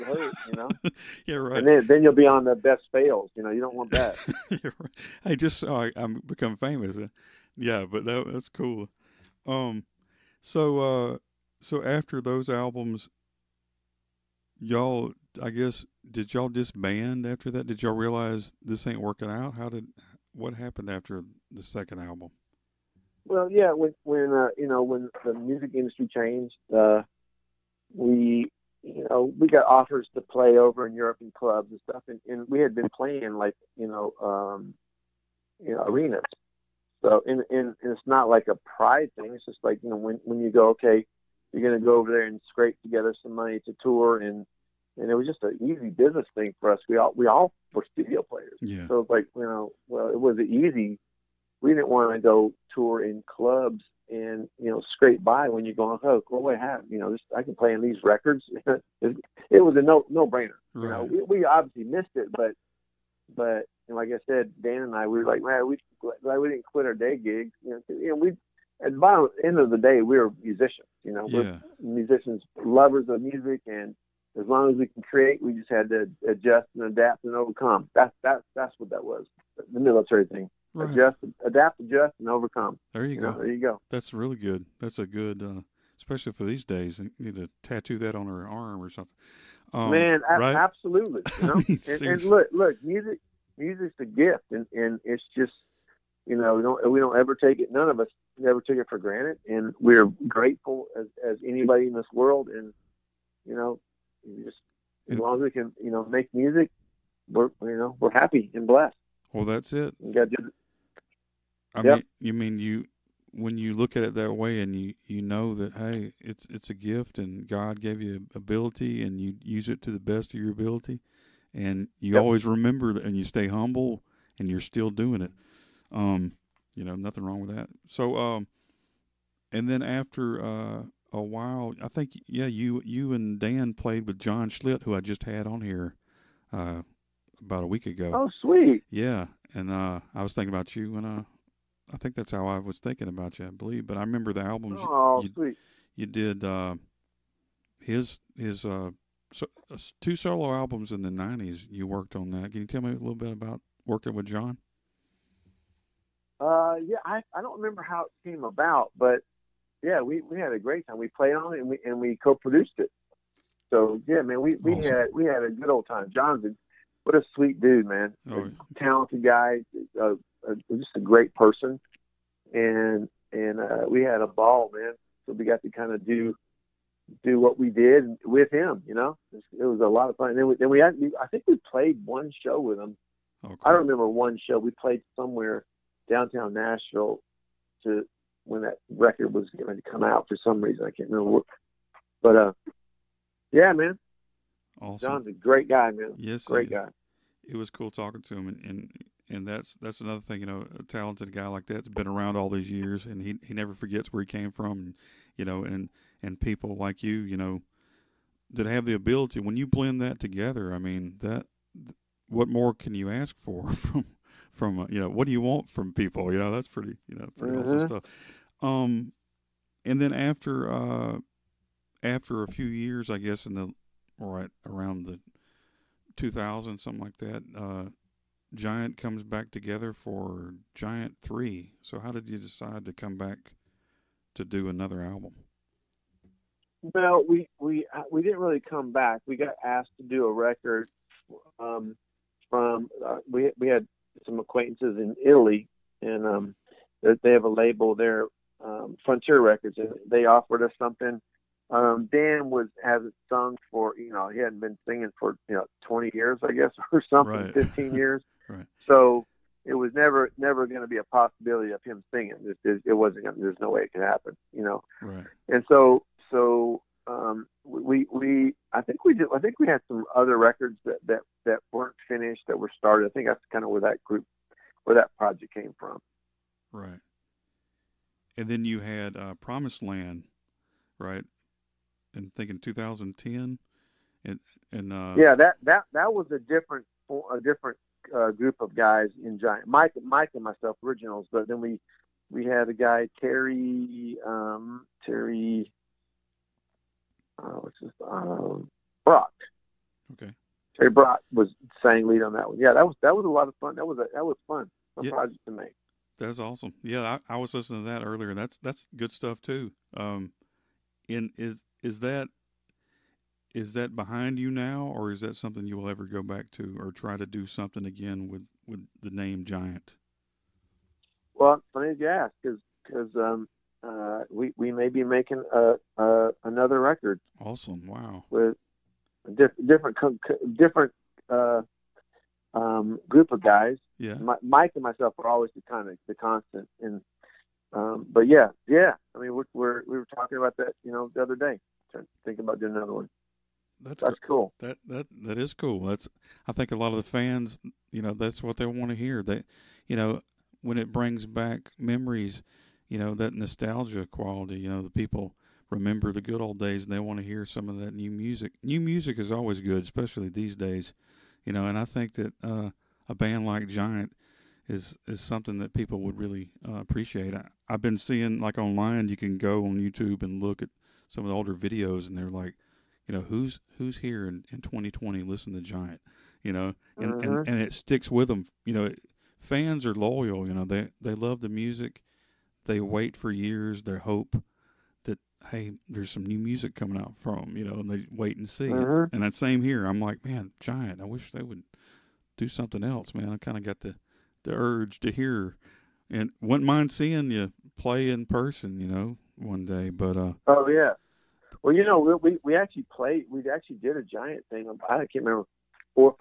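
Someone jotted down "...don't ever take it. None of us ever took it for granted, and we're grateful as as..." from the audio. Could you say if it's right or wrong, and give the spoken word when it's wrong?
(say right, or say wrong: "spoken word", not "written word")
right.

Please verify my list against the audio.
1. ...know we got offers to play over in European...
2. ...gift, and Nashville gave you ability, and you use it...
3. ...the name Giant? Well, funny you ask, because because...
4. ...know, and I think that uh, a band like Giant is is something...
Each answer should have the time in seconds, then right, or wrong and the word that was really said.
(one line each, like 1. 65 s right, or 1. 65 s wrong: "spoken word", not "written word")
1. 29 s right
2. 116 s wrong: "God", not "Nashville"
3. 319 s right
4. 361 s right.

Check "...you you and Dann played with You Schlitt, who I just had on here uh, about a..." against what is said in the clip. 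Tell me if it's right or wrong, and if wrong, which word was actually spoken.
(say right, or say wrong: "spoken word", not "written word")
wrong: "John", not "You".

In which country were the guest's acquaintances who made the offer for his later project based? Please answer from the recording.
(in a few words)
Italy.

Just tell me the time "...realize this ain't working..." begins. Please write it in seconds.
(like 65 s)
17 s.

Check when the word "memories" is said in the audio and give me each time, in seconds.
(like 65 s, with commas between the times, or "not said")
351 s.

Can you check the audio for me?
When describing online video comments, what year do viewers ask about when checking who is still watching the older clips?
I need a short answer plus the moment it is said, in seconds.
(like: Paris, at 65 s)
2020, at 374 s.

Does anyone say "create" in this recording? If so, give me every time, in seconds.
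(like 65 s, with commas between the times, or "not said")
75 s.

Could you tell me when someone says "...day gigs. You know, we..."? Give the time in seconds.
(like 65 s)
66 s.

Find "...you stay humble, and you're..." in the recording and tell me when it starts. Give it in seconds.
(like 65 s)
123 s.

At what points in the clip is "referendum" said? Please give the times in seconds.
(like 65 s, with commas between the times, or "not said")
not said.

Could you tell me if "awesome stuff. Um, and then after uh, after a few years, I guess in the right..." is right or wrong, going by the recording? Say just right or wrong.
right.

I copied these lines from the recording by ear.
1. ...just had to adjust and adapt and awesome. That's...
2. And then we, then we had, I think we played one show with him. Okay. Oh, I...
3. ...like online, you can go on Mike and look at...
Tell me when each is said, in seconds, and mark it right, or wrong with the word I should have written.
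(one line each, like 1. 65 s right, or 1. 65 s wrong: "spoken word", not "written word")
1. 75 s wrong: "overcome", not "awesome"
2. 180 s right
3. 368 s wrong: "YouTube", not "Mike".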